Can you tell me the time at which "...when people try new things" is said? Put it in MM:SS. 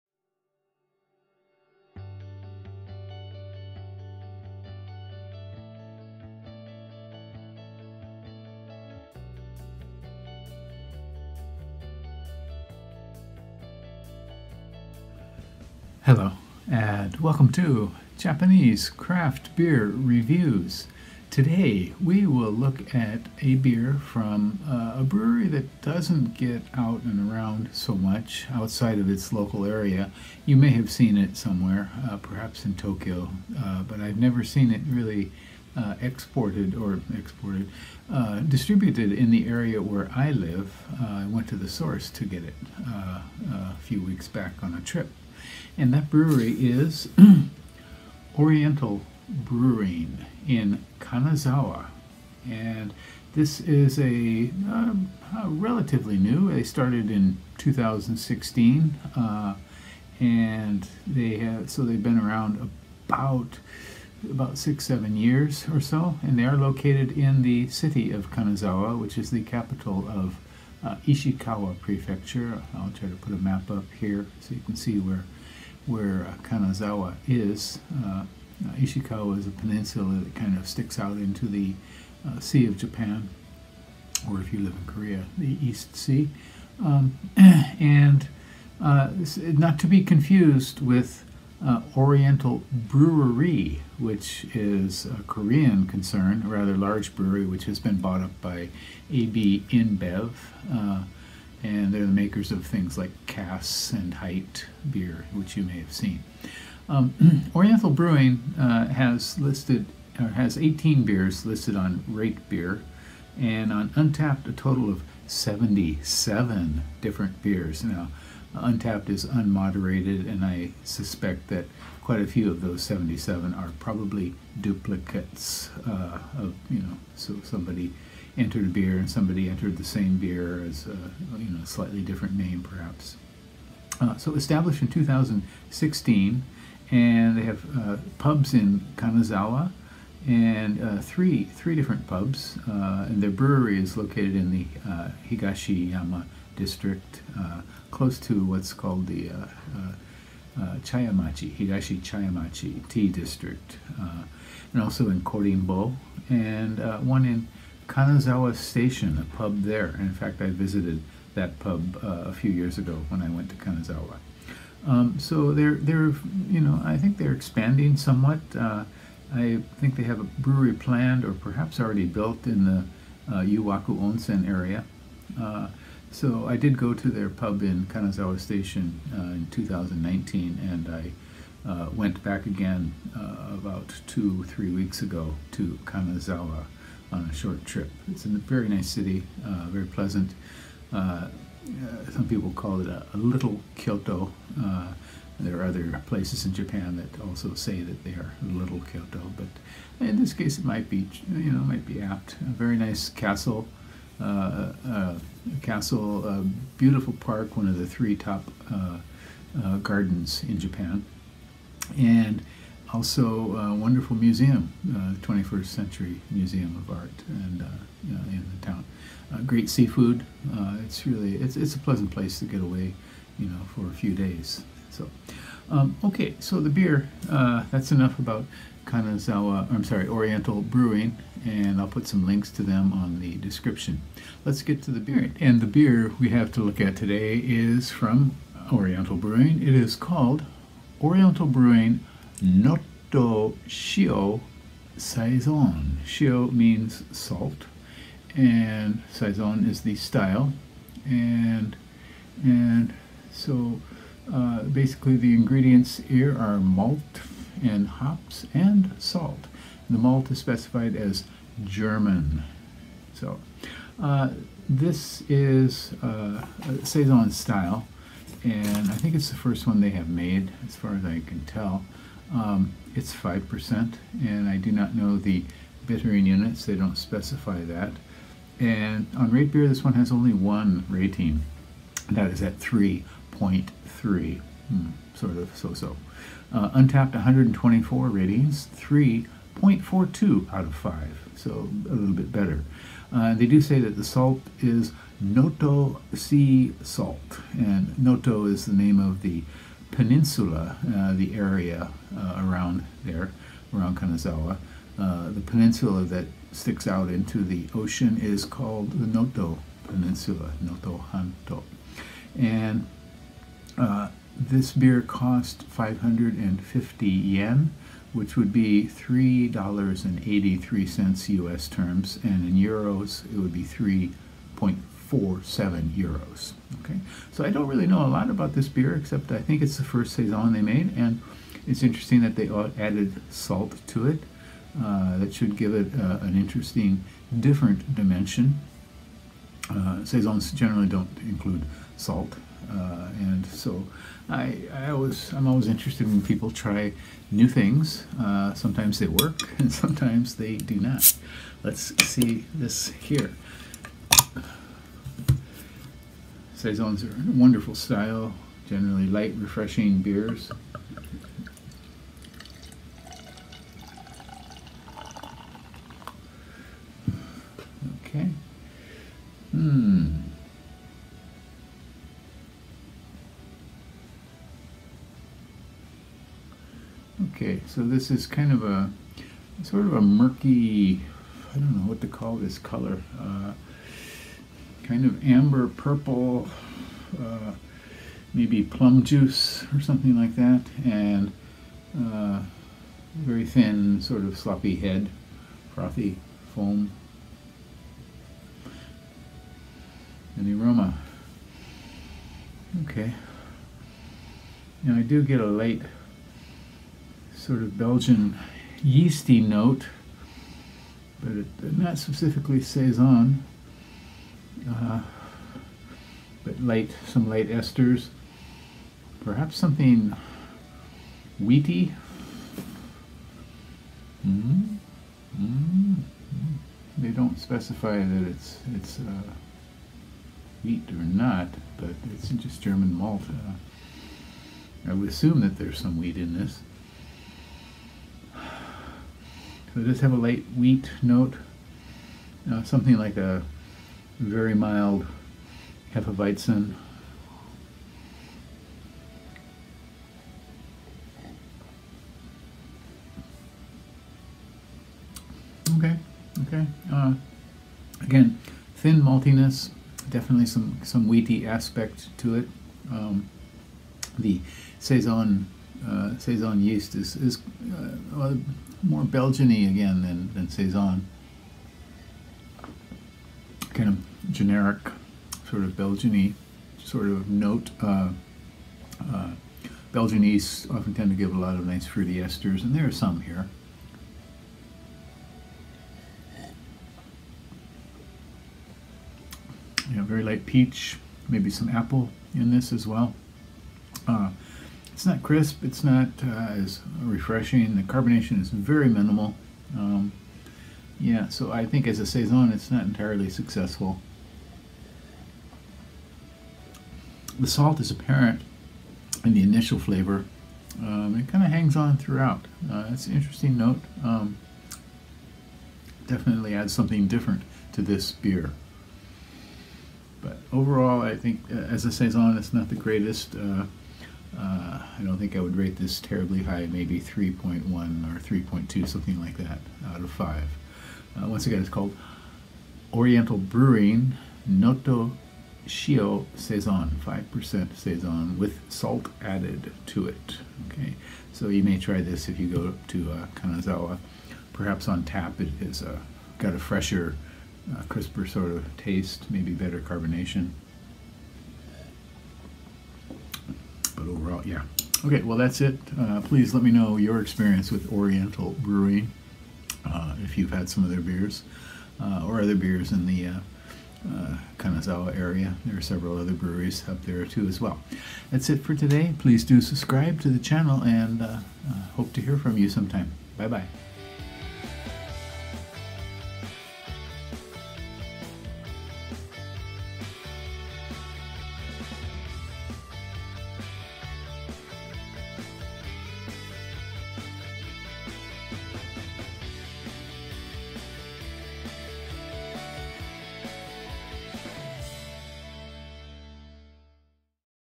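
05:46.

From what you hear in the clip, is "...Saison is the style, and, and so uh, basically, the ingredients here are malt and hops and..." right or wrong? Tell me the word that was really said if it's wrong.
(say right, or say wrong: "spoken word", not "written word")
right.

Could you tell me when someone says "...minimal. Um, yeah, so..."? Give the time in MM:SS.
08:18.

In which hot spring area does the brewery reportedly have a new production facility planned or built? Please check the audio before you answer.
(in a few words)
Yuwaku Onsen.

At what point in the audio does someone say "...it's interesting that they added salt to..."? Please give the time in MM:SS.
05:31.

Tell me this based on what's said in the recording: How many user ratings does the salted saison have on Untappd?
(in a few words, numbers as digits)
124.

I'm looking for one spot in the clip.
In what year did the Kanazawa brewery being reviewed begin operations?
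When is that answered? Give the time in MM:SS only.
00:56.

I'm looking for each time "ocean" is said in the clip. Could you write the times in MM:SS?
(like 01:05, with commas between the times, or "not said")
05:07.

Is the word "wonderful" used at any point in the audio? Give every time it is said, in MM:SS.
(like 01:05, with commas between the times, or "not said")
03:33, 05:57.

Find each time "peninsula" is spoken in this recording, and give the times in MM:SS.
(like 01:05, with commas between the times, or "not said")
01:19, 04:59, 05:05, 05:09.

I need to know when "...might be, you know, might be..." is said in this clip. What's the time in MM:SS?
03:20.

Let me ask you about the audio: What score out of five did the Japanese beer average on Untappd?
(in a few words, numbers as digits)
3.42.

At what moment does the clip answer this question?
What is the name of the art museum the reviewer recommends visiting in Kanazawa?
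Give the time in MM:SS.
03:35.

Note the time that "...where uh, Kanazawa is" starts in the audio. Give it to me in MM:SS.
01:15.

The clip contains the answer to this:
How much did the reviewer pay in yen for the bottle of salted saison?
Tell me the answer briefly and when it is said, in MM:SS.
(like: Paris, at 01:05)
550 yen, at 05:15.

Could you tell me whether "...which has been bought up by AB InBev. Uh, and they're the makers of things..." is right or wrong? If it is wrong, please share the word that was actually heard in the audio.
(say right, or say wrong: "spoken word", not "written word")
right.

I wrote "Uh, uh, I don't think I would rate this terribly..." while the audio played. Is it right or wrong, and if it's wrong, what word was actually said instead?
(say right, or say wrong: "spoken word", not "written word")
right.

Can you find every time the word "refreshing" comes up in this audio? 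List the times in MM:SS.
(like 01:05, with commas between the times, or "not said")
05:59, 08:17.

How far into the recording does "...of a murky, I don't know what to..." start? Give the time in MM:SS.
06:19.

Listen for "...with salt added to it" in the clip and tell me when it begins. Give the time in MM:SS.
08:58.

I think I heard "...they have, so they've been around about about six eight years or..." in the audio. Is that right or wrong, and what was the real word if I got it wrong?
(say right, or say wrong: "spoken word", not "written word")
wrong: "seven", not "eight".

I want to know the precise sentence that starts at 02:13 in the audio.
Uh, so established in 2016, and they have uh, pubs in Kanazawa and uh, three three different pubs.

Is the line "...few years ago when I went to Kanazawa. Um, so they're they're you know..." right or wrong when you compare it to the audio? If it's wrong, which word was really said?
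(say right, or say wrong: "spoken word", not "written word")
right.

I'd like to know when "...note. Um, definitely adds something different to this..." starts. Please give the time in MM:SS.
08:33.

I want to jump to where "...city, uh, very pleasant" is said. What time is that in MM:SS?
03:08.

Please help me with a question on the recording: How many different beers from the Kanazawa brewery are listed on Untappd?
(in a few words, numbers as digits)
77.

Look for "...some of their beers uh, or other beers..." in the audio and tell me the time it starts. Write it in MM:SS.
09:20.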